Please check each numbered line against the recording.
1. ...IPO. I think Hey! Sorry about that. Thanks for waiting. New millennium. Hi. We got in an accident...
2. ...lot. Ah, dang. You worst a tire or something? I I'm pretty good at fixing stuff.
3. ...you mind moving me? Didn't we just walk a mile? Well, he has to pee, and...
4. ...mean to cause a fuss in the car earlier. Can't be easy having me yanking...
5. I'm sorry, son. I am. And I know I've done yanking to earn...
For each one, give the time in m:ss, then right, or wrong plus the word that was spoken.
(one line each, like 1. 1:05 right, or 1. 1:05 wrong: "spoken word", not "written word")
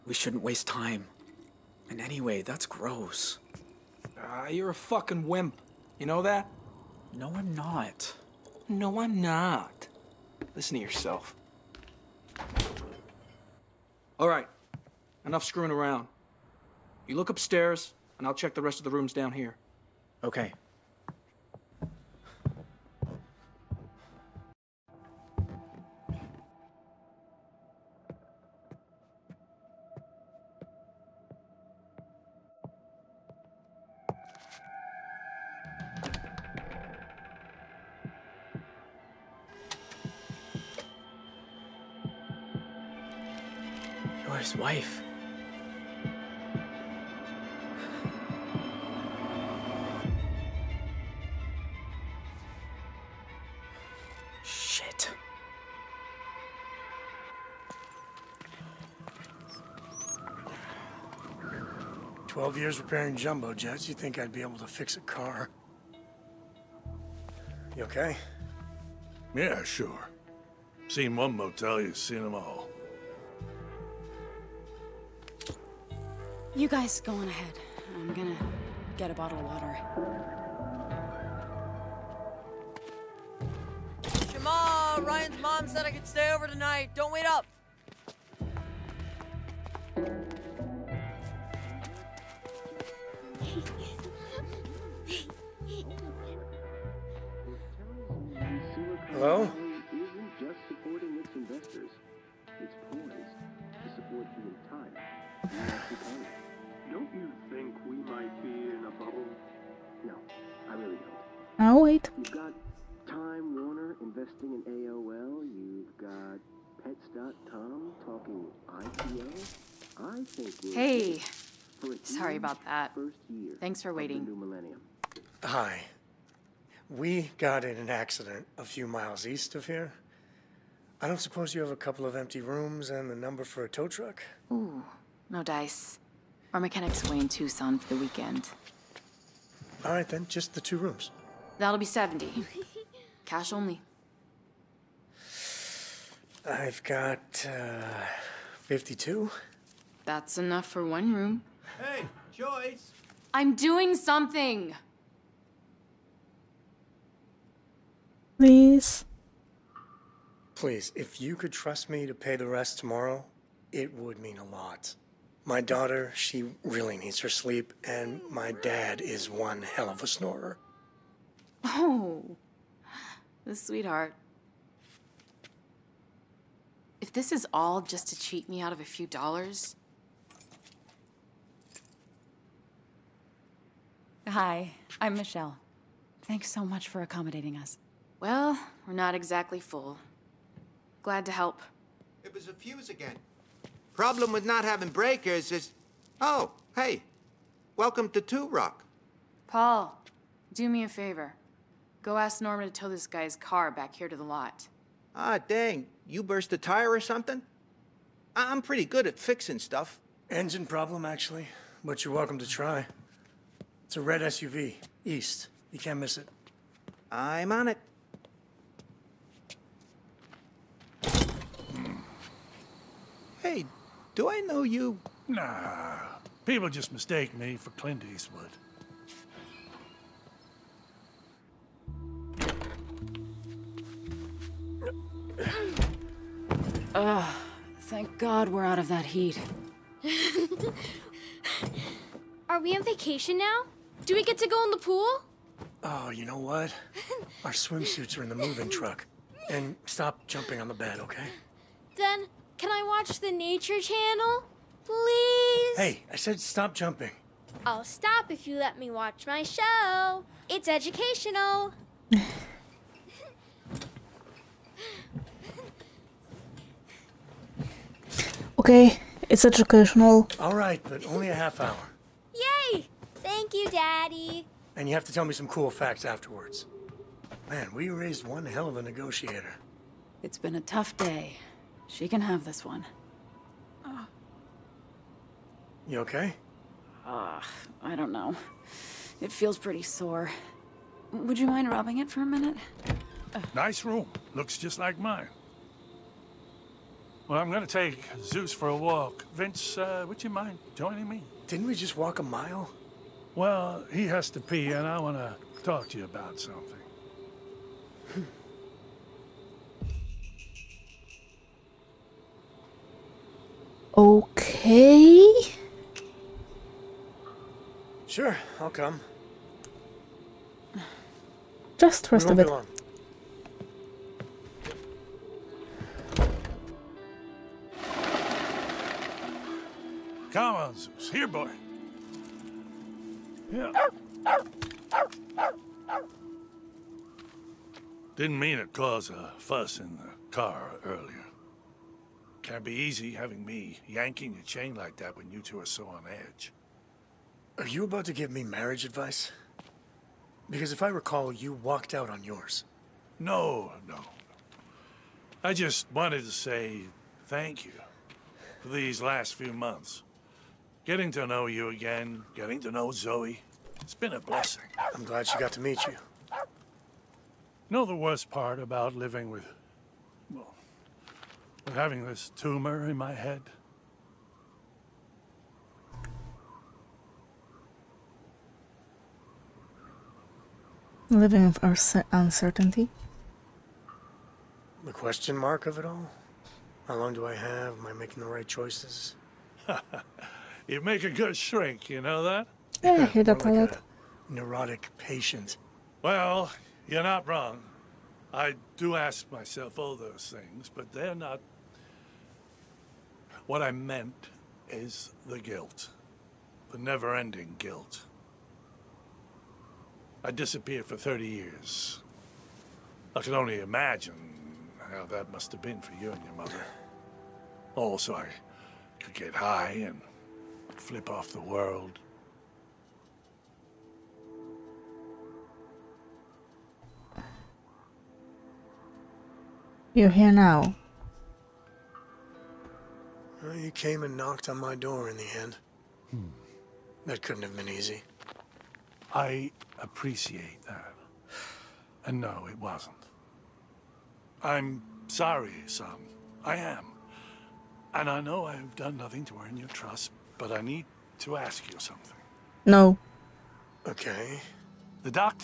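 1. 1:58 right
2. 3:24 wrong: "burst", not "worst"
3. 5:00 wrong: "joining", not "moving"
4. 5:38 right
5. 7:24 wrong: "nothing", not "yanking".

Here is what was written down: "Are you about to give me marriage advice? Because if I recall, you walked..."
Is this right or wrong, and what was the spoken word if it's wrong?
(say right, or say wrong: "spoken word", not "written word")
right.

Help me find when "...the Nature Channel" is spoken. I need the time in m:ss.
4:13.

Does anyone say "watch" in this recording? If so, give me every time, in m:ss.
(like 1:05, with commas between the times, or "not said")
4:12, 4:18.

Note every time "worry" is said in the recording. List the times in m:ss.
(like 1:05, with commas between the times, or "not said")
not said.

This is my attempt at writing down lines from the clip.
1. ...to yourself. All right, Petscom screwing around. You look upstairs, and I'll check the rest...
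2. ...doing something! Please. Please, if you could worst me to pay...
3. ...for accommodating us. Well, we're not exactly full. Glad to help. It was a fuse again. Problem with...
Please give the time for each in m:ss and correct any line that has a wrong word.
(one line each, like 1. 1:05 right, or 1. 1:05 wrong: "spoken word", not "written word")
1. 0:10 wrong: "Enough", not "Petscom"
2. 2:33 wrong: "trust", not "worst"
3. 3:06 right.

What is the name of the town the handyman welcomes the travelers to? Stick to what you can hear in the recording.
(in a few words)
Two Rock.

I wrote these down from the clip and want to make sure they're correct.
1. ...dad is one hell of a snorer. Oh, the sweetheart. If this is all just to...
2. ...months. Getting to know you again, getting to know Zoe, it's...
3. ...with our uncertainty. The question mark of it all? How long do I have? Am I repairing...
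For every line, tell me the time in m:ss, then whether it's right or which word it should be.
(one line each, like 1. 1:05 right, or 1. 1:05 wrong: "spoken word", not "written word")
1. 2:48 right
2. 5:59 right
3. 6:21 wrong: "making", not "repairing".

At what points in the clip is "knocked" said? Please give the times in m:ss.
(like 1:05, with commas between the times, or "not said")
7:14.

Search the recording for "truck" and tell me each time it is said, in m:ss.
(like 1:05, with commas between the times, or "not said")
2:13, 4:08.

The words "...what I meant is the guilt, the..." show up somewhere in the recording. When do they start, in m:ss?
6:43.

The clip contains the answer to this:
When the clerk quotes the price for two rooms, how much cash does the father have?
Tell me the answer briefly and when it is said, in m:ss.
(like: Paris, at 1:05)
52, at 2:28.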